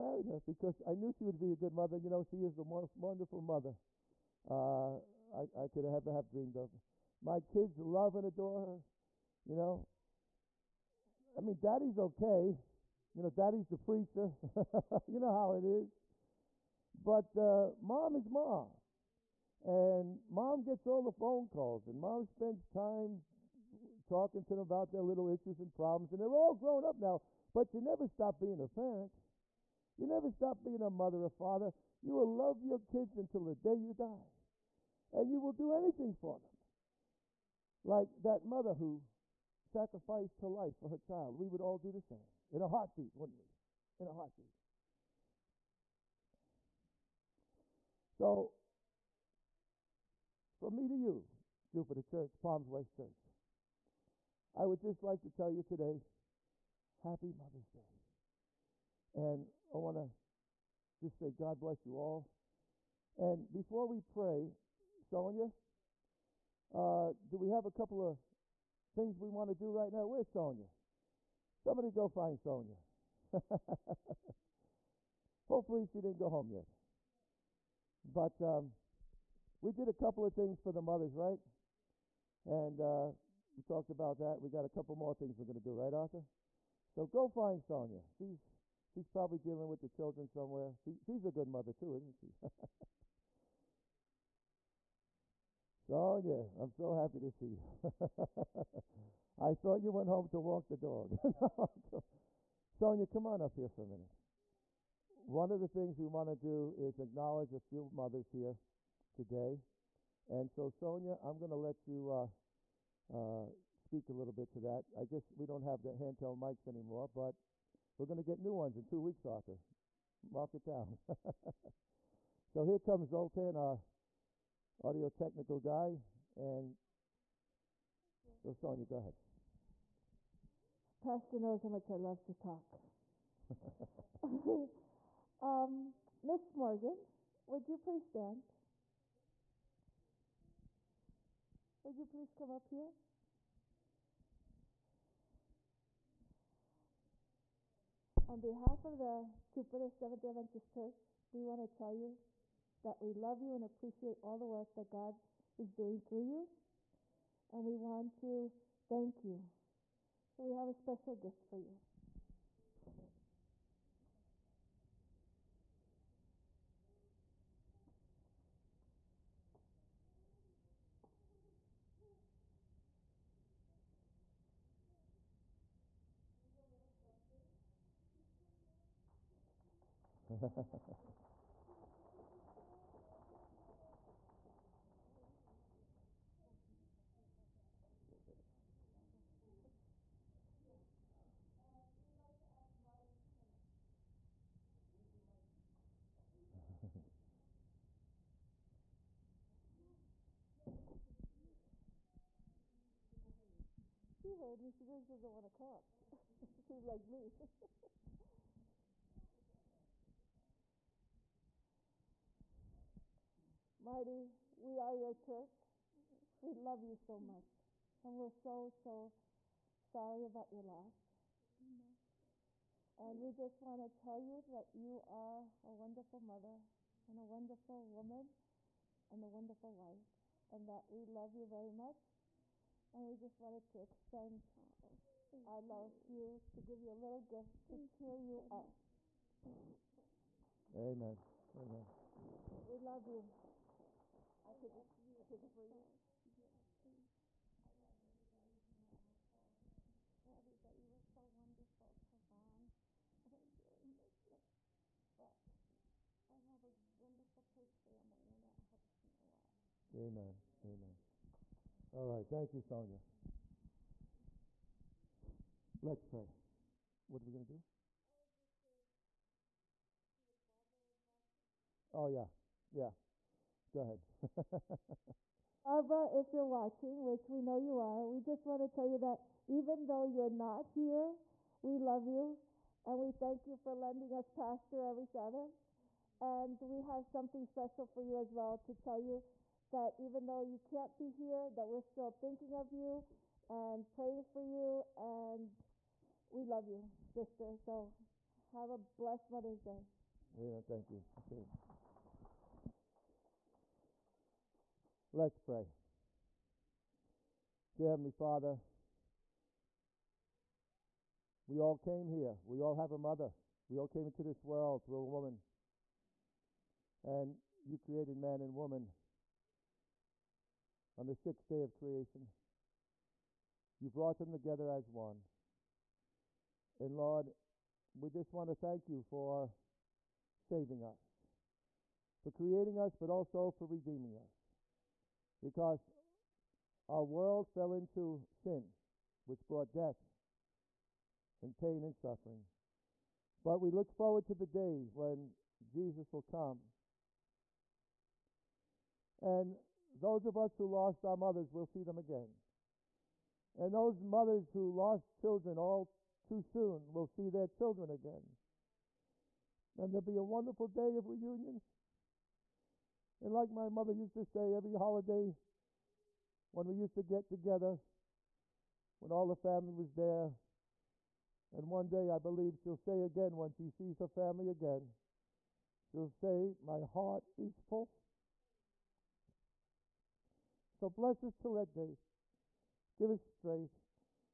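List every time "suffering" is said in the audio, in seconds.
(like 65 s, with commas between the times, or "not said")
342 s.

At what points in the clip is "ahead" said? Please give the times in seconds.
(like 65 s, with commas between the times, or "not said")
128 s, 273 s.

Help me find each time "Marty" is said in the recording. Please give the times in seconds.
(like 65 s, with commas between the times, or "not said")
213 s.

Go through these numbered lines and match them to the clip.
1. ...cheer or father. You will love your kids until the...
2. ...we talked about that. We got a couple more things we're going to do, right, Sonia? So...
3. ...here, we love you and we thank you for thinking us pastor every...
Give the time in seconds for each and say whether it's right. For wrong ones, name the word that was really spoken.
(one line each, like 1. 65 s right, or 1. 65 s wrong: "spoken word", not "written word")
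1. 30 s wrong: "mother", not "cheer"
2. 83 s wrong: "Arthur", not "Sonia"
3. 280 s wrong: "lending", not "thinking".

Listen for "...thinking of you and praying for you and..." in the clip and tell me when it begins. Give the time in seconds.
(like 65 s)
292 s.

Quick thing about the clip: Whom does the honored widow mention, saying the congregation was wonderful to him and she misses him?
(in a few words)
Ron.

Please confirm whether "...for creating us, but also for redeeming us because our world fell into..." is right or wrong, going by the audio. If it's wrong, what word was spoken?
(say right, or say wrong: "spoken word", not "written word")
right.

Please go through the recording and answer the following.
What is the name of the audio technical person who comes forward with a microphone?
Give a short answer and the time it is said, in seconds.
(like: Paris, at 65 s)
Zoltan, at 123 s.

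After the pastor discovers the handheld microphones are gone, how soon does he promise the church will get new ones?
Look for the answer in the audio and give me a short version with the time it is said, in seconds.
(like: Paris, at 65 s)
2 weeks, at 118 s.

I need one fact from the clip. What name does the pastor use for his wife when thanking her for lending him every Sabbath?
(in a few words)
Barbara.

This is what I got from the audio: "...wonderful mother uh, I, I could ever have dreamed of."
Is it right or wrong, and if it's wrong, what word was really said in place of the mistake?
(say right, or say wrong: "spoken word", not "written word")
right.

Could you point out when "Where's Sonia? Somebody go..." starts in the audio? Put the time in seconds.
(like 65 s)
70 s.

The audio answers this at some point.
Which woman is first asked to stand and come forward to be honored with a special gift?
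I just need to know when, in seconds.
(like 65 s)
136 s.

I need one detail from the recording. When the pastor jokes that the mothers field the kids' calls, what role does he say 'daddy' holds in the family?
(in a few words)
the preacher.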